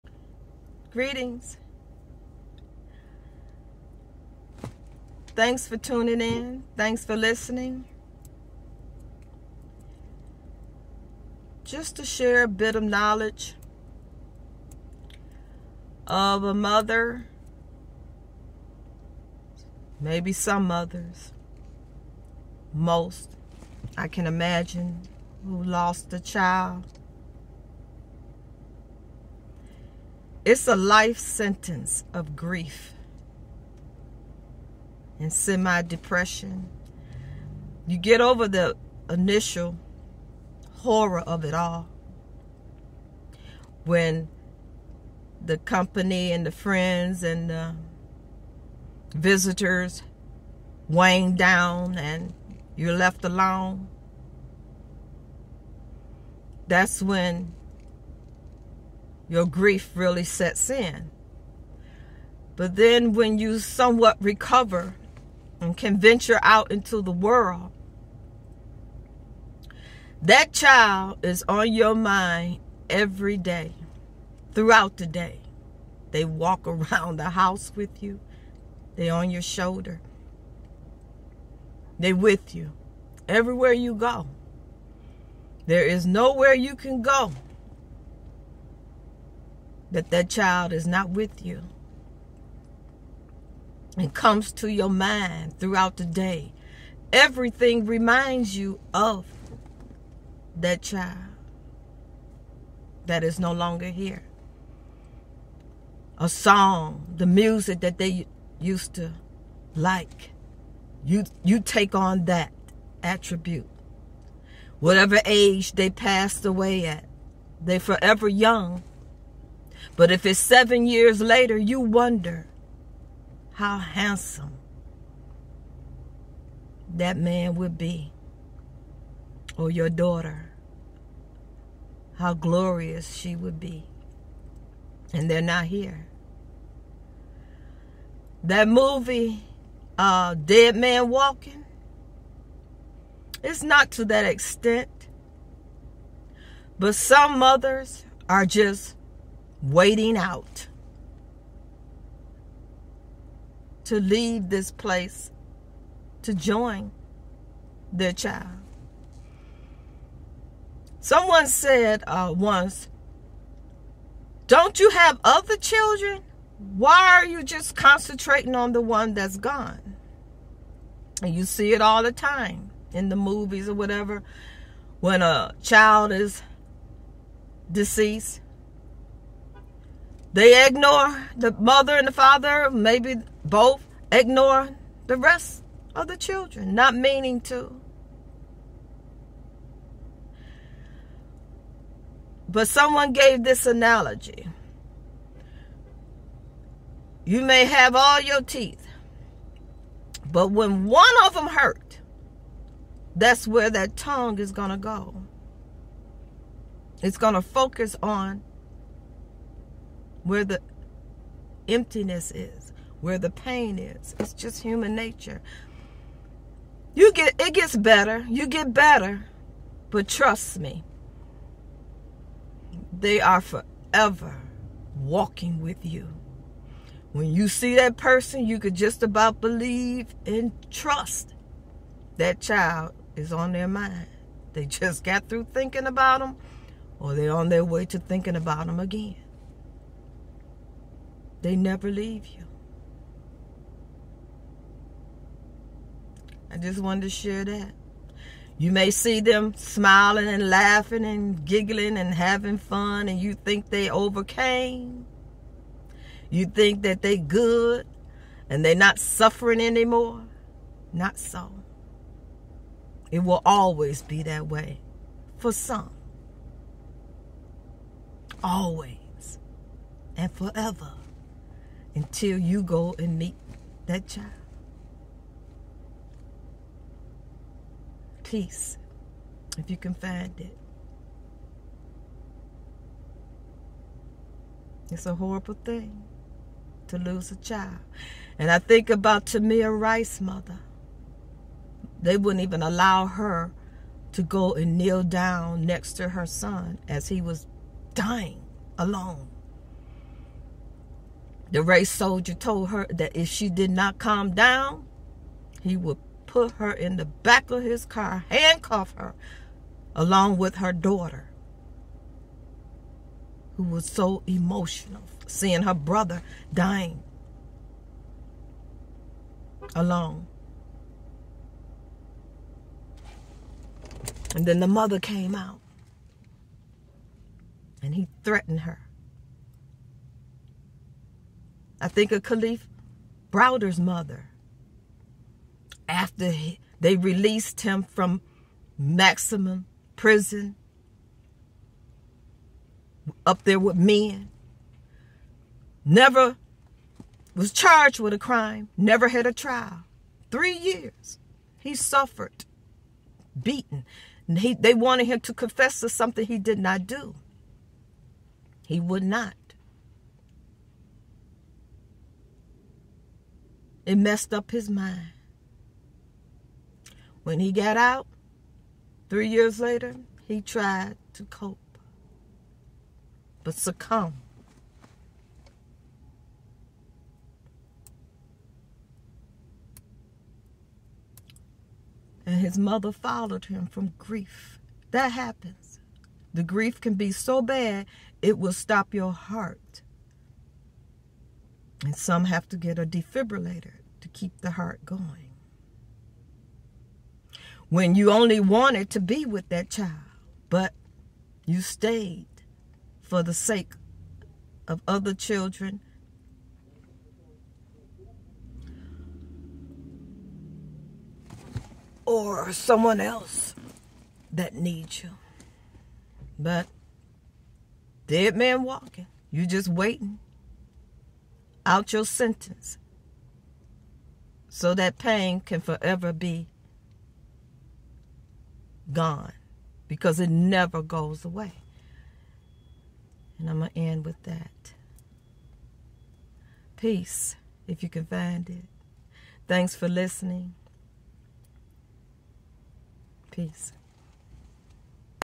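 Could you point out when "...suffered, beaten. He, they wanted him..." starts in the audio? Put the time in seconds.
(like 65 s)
351 s.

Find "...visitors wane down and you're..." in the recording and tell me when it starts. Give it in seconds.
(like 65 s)
49 s.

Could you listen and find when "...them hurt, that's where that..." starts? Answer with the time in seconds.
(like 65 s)
201 s.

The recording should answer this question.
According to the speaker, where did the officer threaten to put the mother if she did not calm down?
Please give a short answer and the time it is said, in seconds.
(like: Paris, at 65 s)
back of his car, at 307 s.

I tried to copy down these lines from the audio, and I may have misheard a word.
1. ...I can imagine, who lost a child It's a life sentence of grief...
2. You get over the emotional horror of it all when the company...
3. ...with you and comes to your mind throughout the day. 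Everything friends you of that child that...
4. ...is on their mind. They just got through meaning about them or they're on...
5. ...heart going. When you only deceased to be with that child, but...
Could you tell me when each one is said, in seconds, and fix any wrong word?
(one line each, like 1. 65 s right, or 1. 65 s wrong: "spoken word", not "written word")
1. 23 s right
2. 37 s wrong: "initial", not "emotional"
3. 91 s wrong: "reminds", not "friends"
4. 233 s wrong: "thinking", not "meaning"
5. 394 s wrong: "wanted", not "deceased".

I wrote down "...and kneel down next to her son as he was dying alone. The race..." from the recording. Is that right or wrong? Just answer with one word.
right.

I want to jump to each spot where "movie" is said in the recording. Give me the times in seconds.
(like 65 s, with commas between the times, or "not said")
138 s, 173 s.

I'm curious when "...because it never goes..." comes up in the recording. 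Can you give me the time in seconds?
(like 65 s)
429 s.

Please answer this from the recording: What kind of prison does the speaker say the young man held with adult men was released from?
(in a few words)
maximum prison.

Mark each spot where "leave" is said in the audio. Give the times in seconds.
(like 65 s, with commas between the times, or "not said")
153 s, 241 s.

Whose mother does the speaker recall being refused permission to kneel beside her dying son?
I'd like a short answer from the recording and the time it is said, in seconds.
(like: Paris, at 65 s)
Tamir Rice, at 289 s.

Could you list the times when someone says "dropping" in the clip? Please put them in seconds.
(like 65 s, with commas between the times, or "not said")
not said.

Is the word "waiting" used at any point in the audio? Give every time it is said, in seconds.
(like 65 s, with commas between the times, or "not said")
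149 s, 419 s.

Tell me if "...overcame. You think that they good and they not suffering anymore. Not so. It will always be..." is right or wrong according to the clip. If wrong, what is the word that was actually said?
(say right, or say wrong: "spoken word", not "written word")
right.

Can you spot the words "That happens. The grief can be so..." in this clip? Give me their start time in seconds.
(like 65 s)
384 s.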